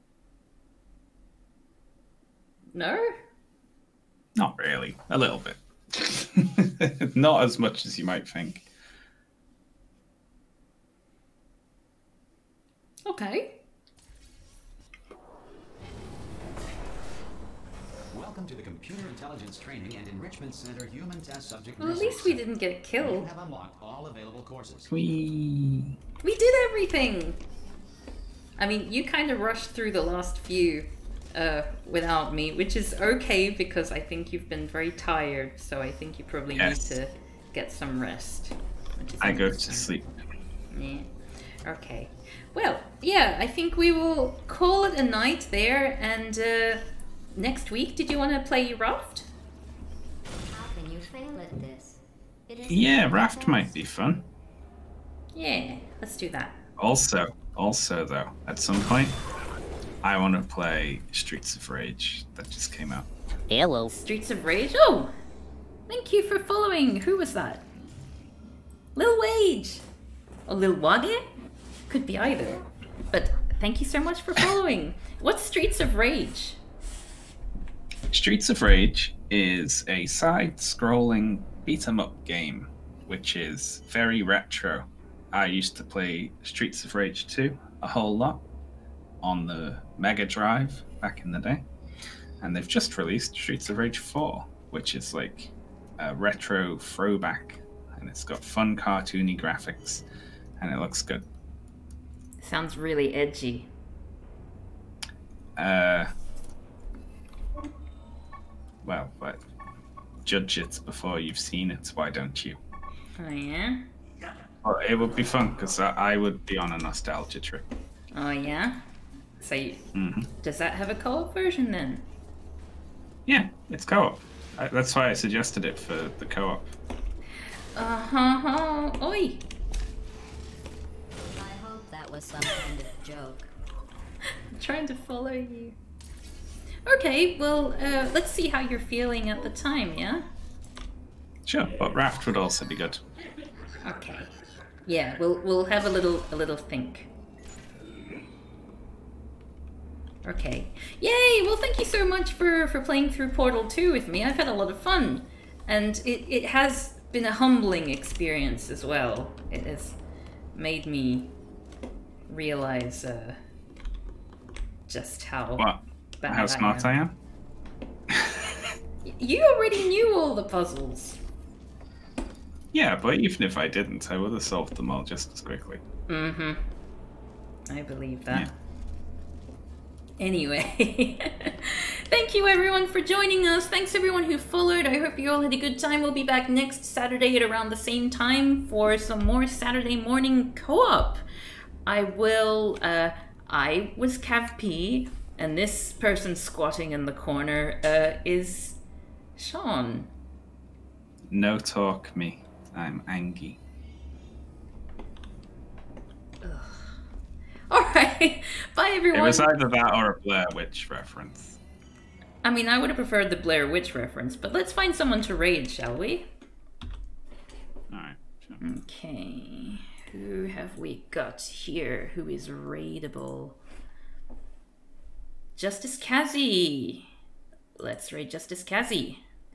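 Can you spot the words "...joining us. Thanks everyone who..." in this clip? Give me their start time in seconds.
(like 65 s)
182 s.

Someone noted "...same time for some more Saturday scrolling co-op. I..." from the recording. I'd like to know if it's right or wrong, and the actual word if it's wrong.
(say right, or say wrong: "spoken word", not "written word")
wrong: "morning", not "scrolling".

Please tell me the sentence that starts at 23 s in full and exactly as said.
We have unlocked all available courses.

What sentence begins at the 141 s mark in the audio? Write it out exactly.
Sure, but raft would also be good.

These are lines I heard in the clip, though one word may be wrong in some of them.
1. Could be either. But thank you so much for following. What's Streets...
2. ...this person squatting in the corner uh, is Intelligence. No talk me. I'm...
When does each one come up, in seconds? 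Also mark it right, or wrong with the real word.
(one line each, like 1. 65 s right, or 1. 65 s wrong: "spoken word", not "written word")
1. 71 s right
2. 195 s wrong: "Shaun", not "Intelligence".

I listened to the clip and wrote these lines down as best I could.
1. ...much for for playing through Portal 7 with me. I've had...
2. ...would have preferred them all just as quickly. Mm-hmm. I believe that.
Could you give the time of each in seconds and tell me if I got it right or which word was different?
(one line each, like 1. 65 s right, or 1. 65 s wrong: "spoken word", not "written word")
1. 152 s wrong: "2", not "7"
2. 174 s wrong: "solved", not "preferred".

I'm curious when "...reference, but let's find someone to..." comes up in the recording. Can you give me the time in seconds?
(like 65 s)
213 s.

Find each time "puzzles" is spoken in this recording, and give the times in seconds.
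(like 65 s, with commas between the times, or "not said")
170 s.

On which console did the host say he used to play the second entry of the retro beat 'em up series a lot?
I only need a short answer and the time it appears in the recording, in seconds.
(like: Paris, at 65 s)
Mega Drive, at 89 s.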